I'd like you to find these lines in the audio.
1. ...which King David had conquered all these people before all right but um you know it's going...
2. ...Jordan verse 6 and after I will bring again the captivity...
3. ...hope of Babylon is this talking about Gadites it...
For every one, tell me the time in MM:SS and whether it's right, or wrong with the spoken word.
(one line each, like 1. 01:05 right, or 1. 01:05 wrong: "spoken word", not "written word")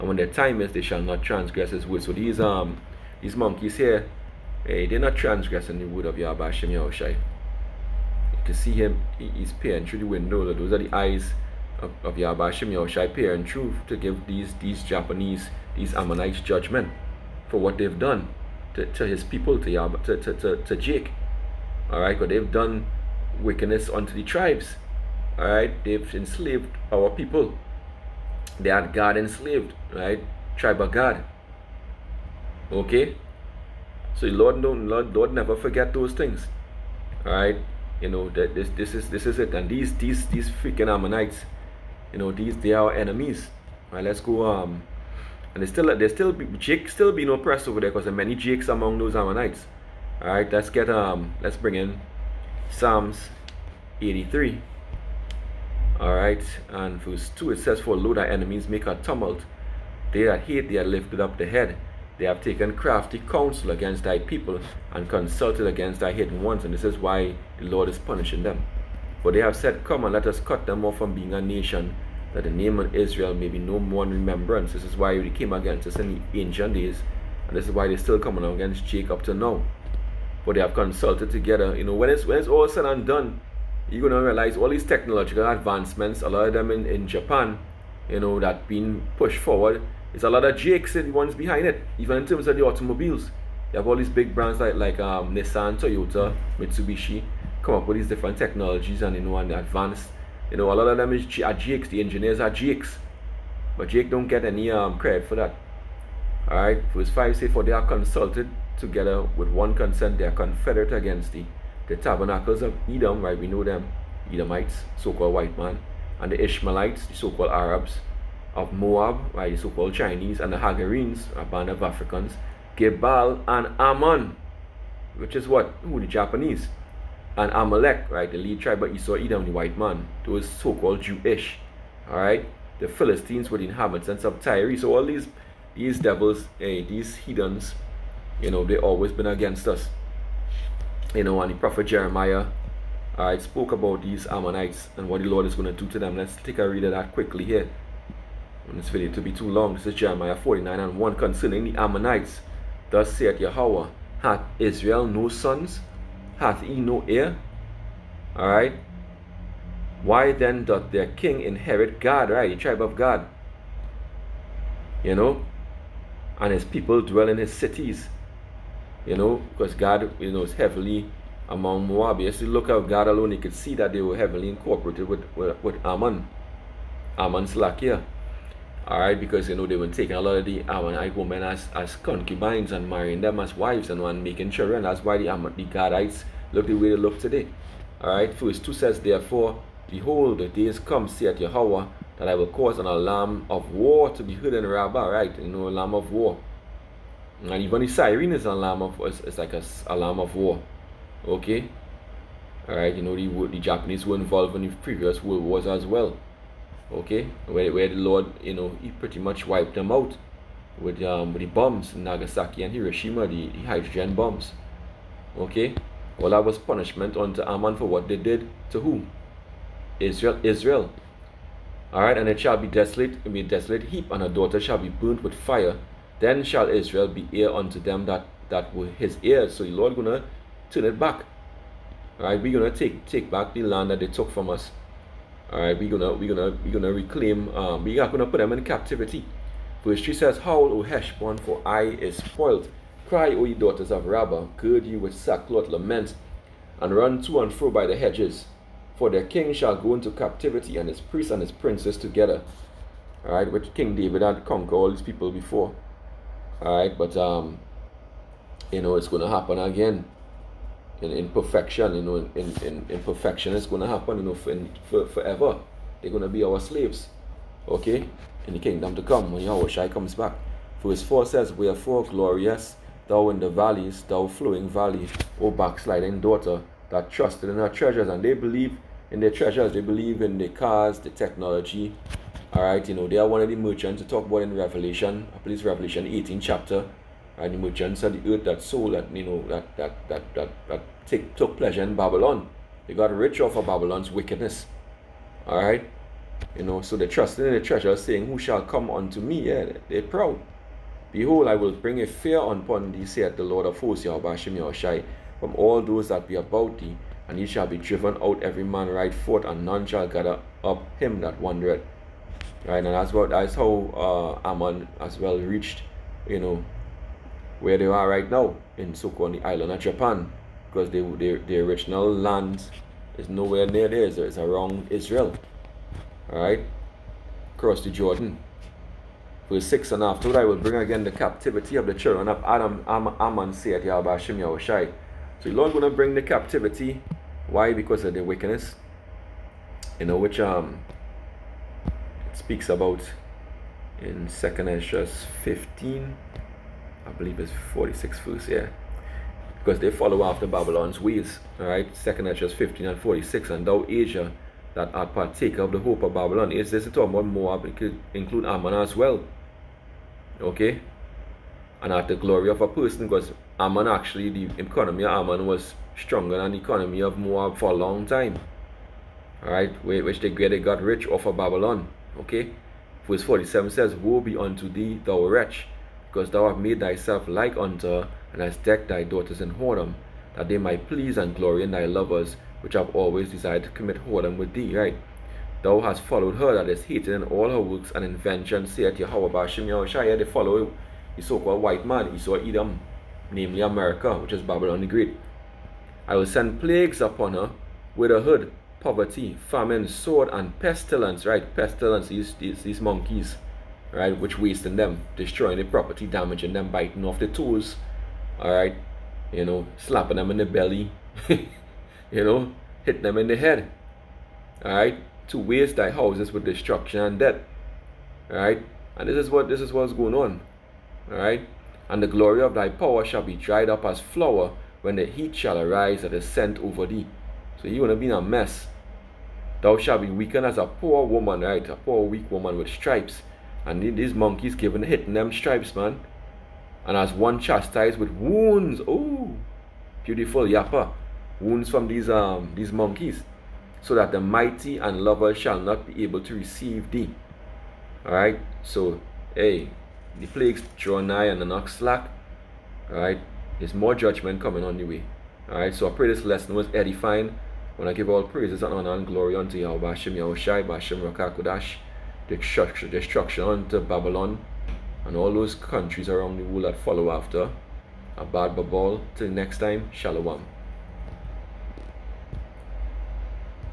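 1. 04:13 right
2. 05:27 right
3. 05:55 wrong: "Moab", not "Gadites".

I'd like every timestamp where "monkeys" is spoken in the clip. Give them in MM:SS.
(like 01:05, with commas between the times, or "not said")
00:03, 06:42, 07:14, 07:22.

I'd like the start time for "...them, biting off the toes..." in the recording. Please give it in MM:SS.
06:46.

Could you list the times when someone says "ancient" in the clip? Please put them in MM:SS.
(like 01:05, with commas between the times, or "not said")
01:16.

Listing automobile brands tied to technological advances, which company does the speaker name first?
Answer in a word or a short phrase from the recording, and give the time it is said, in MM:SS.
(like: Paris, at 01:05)
Nissan, at 01:35.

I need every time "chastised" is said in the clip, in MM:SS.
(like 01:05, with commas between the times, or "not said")
07:17.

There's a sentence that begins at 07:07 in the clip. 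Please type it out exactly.
So you would have been a mess.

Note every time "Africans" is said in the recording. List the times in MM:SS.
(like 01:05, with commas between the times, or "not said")
02:01.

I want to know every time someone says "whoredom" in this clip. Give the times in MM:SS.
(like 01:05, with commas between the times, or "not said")
06:19, 06:24.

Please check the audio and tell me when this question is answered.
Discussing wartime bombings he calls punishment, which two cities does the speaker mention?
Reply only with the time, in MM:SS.
03:32.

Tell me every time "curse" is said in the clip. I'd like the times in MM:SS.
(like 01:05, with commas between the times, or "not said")
not said.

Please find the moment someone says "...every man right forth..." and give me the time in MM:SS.
05:08.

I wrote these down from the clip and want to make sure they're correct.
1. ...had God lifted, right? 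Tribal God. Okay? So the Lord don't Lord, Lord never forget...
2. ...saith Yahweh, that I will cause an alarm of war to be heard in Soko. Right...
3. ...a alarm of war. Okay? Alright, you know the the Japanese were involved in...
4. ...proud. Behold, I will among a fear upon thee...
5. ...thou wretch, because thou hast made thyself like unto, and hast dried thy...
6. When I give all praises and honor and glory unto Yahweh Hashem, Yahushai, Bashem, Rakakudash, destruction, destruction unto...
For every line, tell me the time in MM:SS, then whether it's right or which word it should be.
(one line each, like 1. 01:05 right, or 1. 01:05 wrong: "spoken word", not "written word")
1. 00:28 wrong: "enslaved", not "lifted"
2. 03:11 wrong: "Rabbah", not "Soko"
3. 03:19 right
4. 05:00 wrong: "bring", not "among"
5. 06:15 wrong: "decked", not "dried"
6. 07:37 right.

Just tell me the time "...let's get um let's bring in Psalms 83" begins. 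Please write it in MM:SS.
00:50.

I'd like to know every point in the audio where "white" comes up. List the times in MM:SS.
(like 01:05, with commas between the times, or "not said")
01:55, 02:09, 06:31.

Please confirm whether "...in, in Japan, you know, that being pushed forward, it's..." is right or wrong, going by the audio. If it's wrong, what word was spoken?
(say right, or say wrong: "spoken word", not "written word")
right.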